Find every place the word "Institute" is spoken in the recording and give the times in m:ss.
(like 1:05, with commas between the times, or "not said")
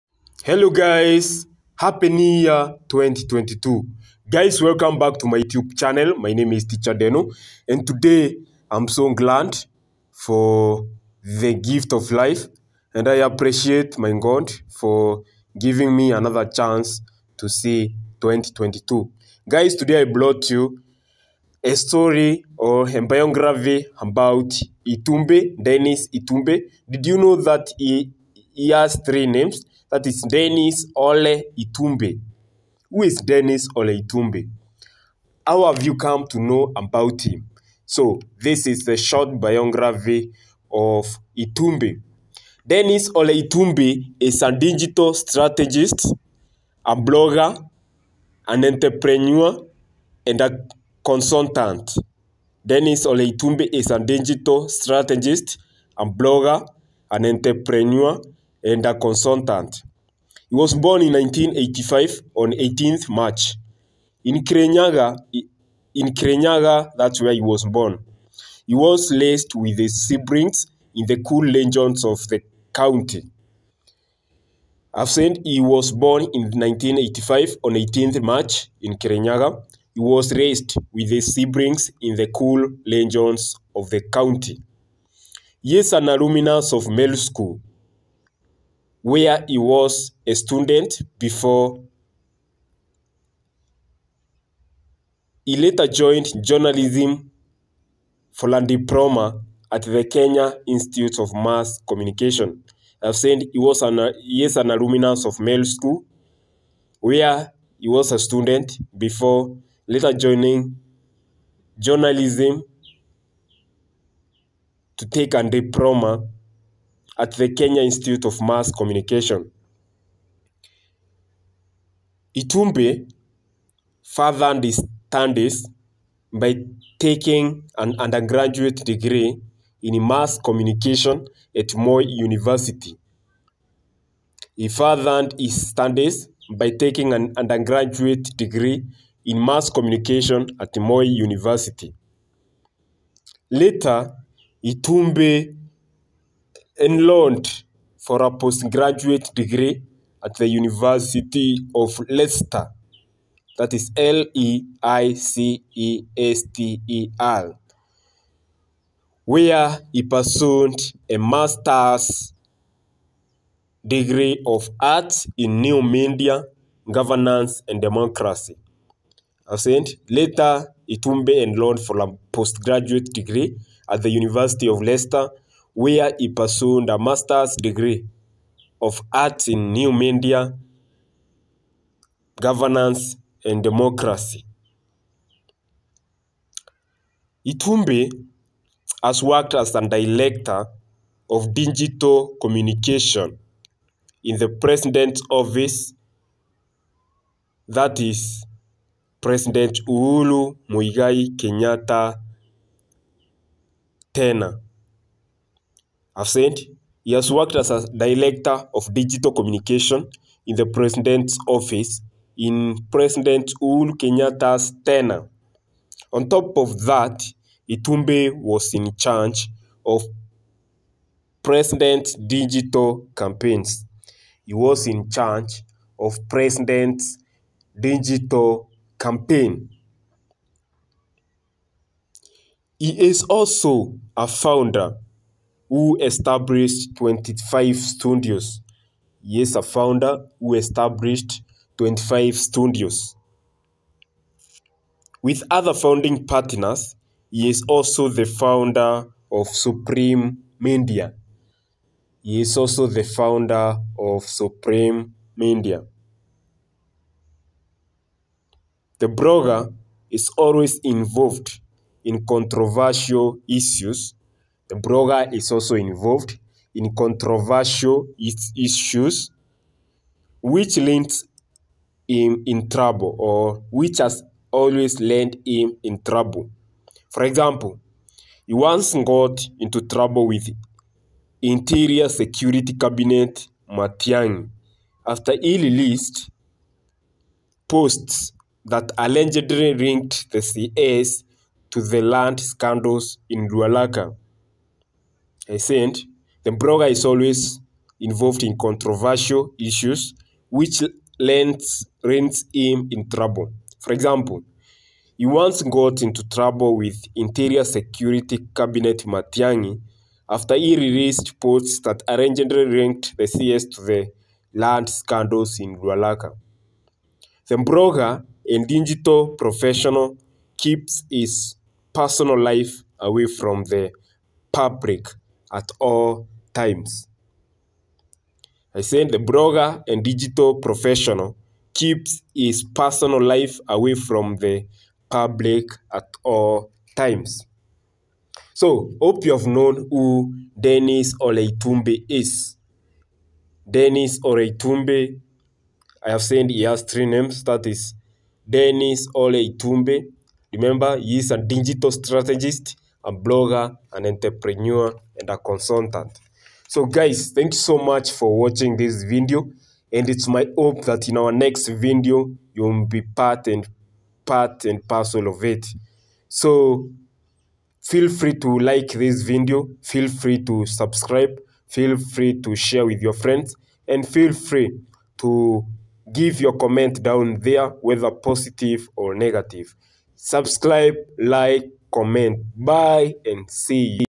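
1:40, 1:57.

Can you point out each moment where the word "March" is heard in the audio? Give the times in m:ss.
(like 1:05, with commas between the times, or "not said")
1:03, 1:18.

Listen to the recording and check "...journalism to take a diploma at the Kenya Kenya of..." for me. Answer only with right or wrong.
wrong.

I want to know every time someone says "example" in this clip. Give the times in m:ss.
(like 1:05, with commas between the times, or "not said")
4:37, 5:03.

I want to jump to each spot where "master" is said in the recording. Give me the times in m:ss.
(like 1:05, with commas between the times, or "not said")
2:41, 2:56.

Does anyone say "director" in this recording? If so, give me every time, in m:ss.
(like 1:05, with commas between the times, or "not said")
3:09, 3:27.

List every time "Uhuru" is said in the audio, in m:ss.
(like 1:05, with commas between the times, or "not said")
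3:19, 3:33.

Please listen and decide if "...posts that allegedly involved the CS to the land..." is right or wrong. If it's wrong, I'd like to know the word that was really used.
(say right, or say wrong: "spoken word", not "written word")
wrong: "linked", not "involved".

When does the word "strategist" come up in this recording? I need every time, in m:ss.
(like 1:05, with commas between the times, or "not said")
0:45, 0:54, 5:51.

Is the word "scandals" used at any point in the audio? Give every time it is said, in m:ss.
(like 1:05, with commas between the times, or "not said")
4:52, 5:14.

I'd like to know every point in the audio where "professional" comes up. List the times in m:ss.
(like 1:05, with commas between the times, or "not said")
5:19, 5:30.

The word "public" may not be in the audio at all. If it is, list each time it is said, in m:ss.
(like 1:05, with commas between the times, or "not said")
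5:24, 5:35.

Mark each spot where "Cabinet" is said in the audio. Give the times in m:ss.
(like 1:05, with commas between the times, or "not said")
4:42, 5:08.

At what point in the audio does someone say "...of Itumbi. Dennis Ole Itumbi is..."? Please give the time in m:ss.
0:40.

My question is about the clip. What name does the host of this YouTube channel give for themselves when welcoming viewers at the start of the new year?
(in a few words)
Teacher Deno.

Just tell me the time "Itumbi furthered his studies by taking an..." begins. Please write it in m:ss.
2:02.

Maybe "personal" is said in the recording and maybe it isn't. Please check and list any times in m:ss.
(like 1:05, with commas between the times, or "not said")
5:21, 5:32.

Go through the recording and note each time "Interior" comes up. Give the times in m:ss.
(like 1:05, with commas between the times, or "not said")
4:41, 5:07.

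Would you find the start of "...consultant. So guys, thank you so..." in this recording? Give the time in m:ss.
5:55.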